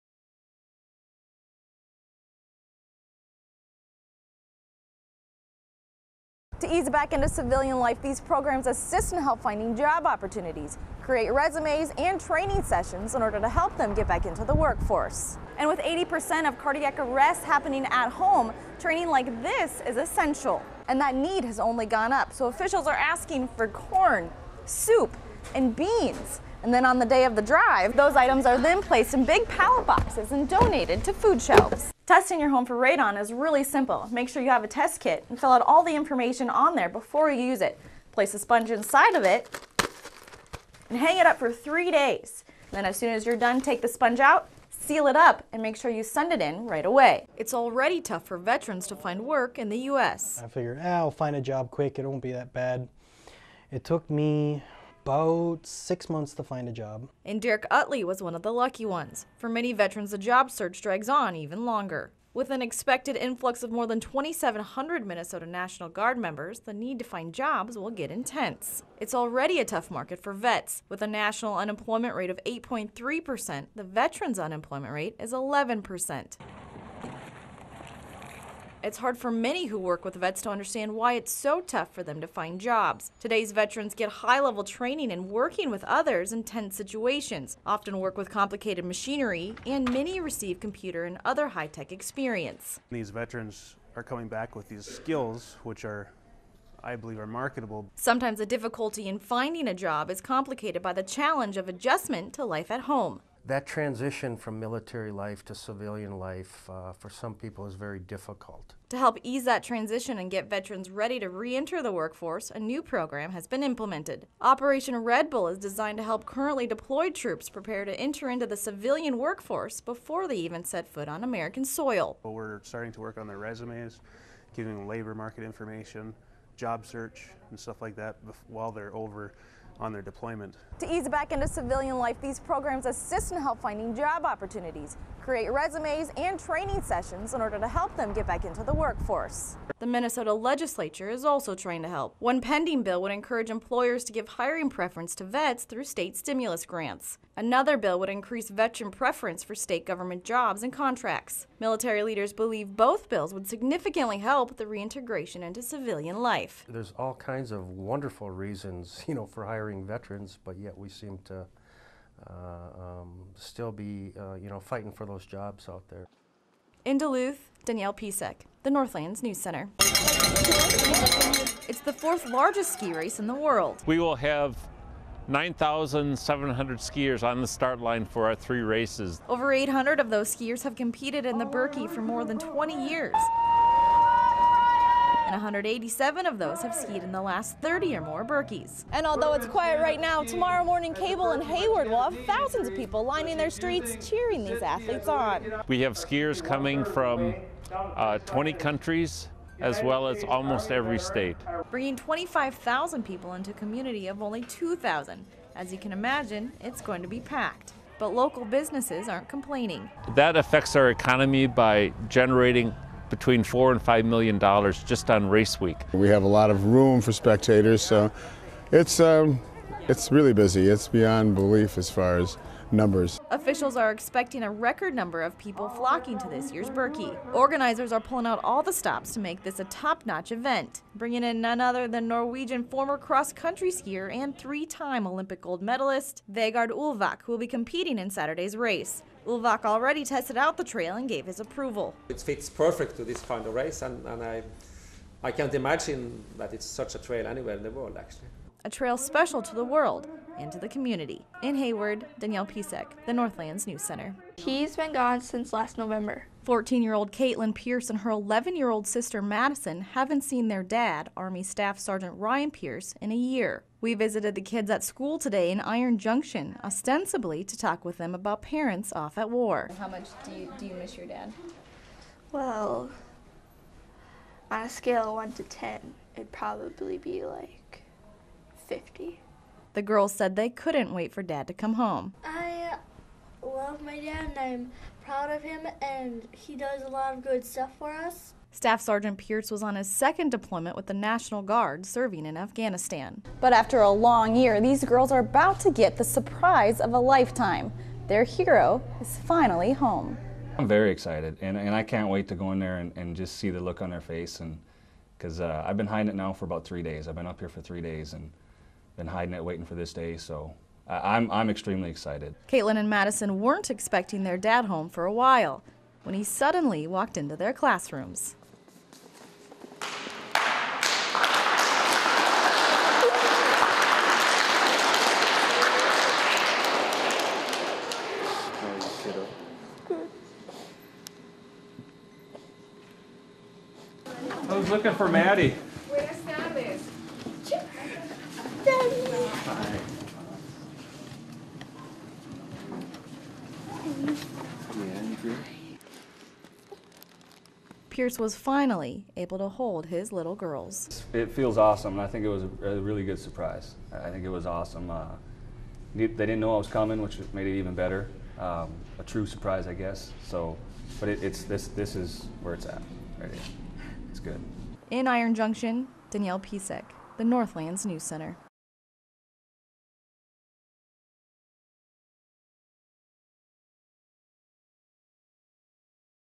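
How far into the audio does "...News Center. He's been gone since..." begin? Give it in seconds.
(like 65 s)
253 s.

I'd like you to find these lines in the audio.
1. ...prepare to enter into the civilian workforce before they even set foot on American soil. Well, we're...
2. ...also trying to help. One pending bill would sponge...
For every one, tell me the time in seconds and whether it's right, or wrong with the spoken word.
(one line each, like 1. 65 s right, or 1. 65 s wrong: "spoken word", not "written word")
1. 117 s right
2. 141 s wrong: "encourage", not "sponge".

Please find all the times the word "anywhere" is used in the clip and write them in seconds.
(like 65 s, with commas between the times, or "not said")
247 s.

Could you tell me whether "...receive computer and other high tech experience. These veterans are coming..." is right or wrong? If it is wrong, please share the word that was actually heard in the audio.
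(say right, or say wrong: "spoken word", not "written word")
right.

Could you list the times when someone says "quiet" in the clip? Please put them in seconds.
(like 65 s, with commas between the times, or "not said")
189 s.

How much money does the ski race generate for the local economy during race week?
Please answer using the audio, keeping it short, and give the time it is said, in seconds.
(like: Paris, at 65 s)
4 to 5 million dollars, at 213 s.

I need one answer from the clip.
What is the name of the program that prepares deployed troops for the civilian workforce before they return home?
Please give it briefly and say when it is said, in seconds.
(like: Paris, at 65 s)
Operation Red Bull, at 114 s.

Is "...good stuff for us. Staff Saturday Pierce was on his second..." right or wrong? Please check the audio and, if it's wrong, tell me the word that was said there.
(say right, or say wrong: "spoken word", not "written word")
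wrong: "Sergeant", not "Saturday".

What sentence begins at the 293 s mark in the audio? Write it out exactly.
But after a long year, these girls are about to get the surprise of a lifetime.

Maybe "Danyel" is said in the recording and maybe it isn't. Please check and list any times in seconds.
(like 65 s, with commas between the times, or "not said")
167 s, 252 s, 366 s.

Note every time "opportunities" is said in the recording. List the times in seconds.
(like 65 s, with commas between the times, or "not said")
10 s, 134 s.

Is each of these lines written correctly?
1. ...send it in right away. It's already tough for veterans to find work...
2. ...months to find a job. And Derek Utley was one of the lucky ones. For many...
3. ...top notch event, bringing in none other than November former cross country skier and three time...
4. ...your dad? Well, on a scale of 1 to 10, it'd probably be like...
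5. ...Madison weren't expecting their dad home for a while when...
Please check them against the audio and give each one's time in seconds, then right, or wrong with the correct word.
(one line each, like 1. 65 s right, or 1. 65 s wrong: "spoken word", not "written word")
1. 46 s right
2. 56 s right
3. 229 s wrong: "Norwegian", not "November"
4. 270 s right
5. 312 s right.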